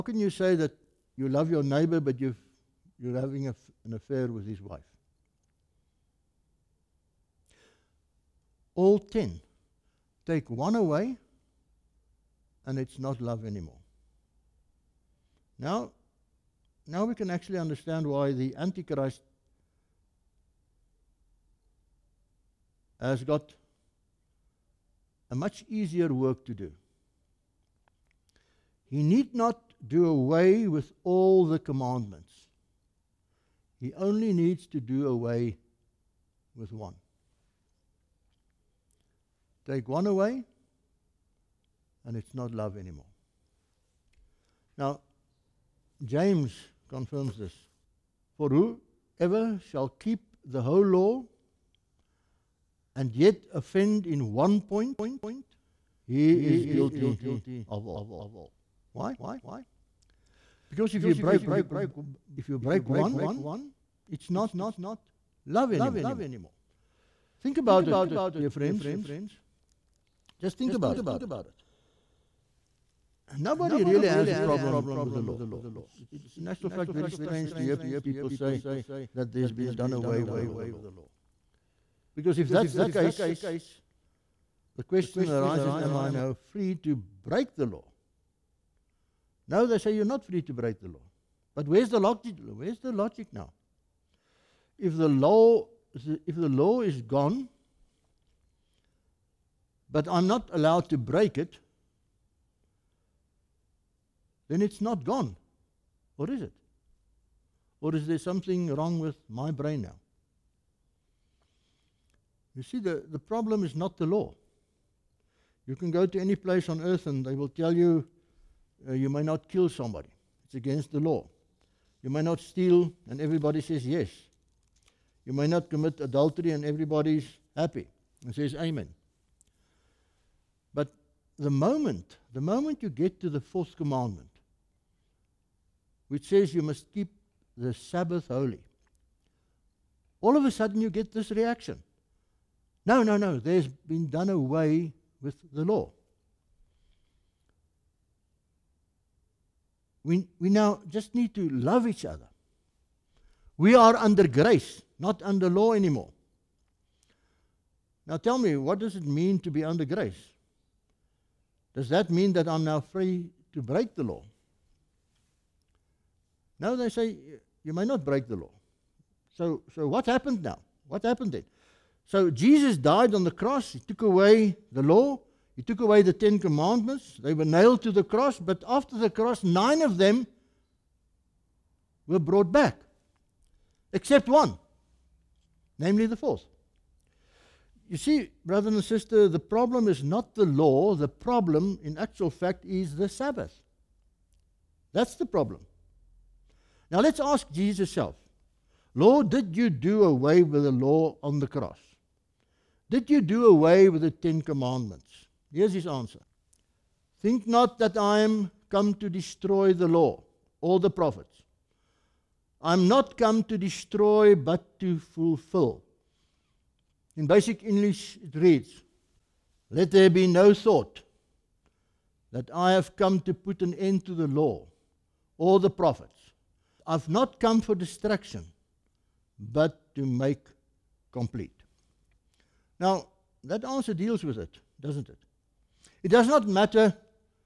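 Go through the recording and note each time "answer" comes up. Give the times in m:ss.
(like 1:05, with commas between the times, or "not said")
3:25, 3:53.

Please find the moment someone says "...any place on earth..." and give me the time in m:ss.
1:56.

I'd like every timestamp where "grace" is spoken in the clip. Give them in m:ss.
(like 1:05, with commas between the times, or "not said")
2:34, 2:39.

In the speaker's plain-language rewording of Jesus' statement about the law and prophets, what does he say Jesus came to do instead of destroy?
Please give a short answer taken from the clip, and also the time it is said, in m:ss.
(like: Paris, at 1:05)
Make complete, at 3:50.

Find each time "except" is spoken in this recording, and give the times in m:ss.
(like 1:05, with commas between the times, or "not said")
3:03.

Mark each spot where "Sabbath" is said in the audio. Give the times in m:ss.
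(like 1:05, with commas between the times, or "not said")
2:17, 3:13.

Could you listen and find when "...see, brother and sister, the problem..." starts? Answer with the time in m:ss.
3:07.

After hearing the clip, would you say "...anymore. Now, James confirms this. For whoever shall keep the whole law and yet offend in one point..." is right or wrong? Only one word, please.
right.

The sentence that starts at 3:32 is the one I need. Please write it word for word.
I'm not come to destroy but to fulfill.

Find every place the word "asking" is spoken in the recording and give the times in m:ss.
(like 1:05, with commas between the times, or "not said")
not said.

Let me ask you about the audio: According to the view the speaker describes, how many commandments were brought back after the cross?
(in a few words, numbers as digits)
9.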